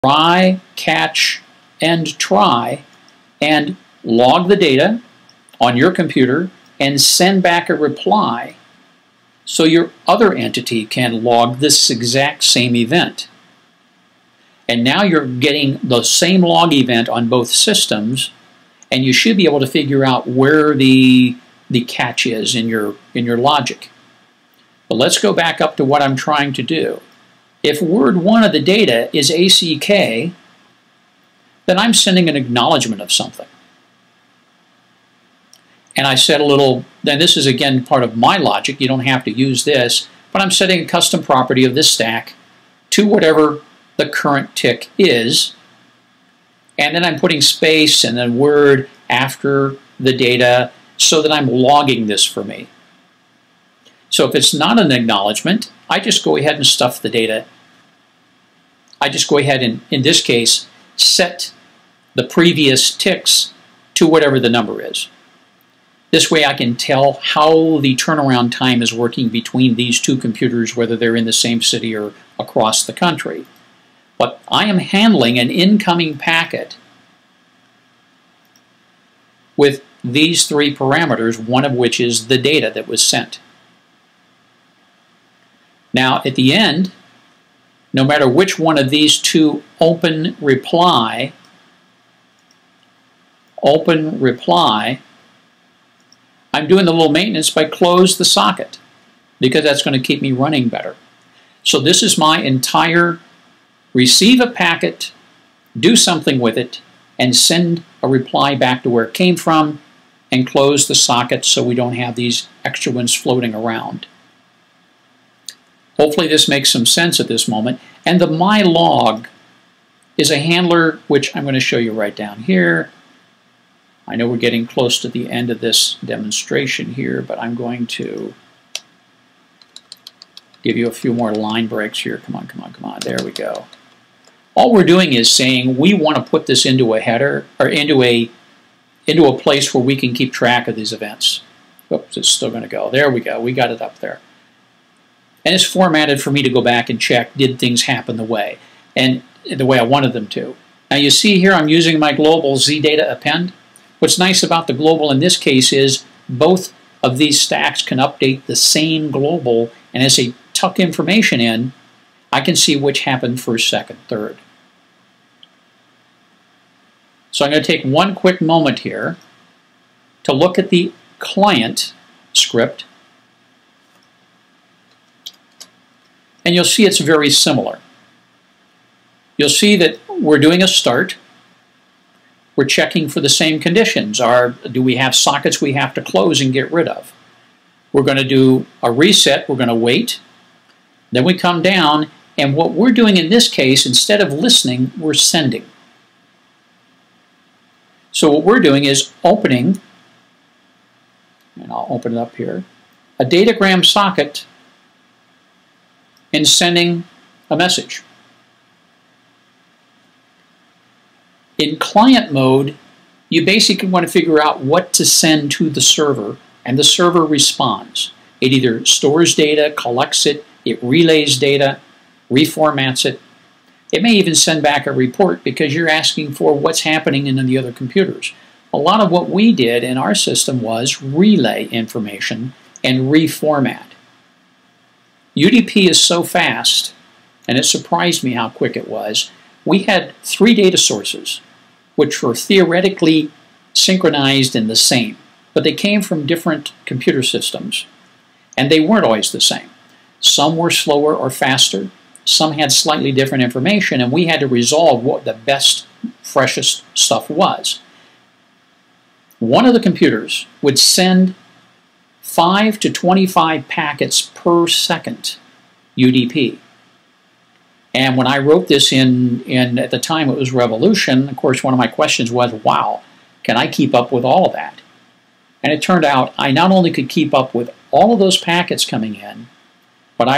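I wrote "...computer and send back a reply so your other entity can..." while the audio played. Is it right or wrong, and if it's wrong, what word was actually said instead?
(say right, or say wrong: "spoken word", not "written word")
right.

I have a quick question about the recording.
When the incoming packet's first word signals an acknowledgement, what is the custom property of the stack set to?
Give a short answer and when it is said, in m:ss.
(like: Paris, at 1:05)
the current tick, at 0:43.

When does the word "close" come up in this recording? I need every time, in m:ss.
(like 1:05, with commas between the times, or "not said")
1:37, 1:50, 2:04, 3:06.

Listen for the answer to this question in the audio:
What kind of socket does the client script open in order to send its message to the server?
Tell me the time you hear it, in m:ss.
3:23.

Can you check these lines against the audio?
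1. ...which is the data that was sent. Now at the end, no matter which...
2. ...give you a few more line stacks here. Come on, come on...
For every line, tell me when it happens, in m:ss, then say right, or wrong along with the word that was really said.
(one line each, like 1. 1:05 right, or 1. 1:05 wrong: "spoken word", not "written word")
1. 1:21 right
2. 2:10 wrong: "breaks", not "stacks".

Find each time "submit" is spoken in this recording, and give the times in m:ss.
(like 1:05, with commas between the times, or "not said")
not said.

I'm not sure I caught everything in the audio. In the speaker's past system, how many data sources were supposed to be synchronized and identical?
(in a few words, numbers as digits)
3.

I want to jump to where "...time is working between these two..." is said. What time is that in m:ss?
1:08.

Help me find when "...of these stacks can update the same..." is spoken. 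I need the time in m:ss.
2:37.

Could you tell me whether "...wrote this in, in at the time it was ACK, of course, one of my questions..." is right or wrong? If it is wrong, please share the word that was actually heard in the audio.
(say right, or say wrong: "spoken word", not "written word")
wrong: "Revolution", not "ACK".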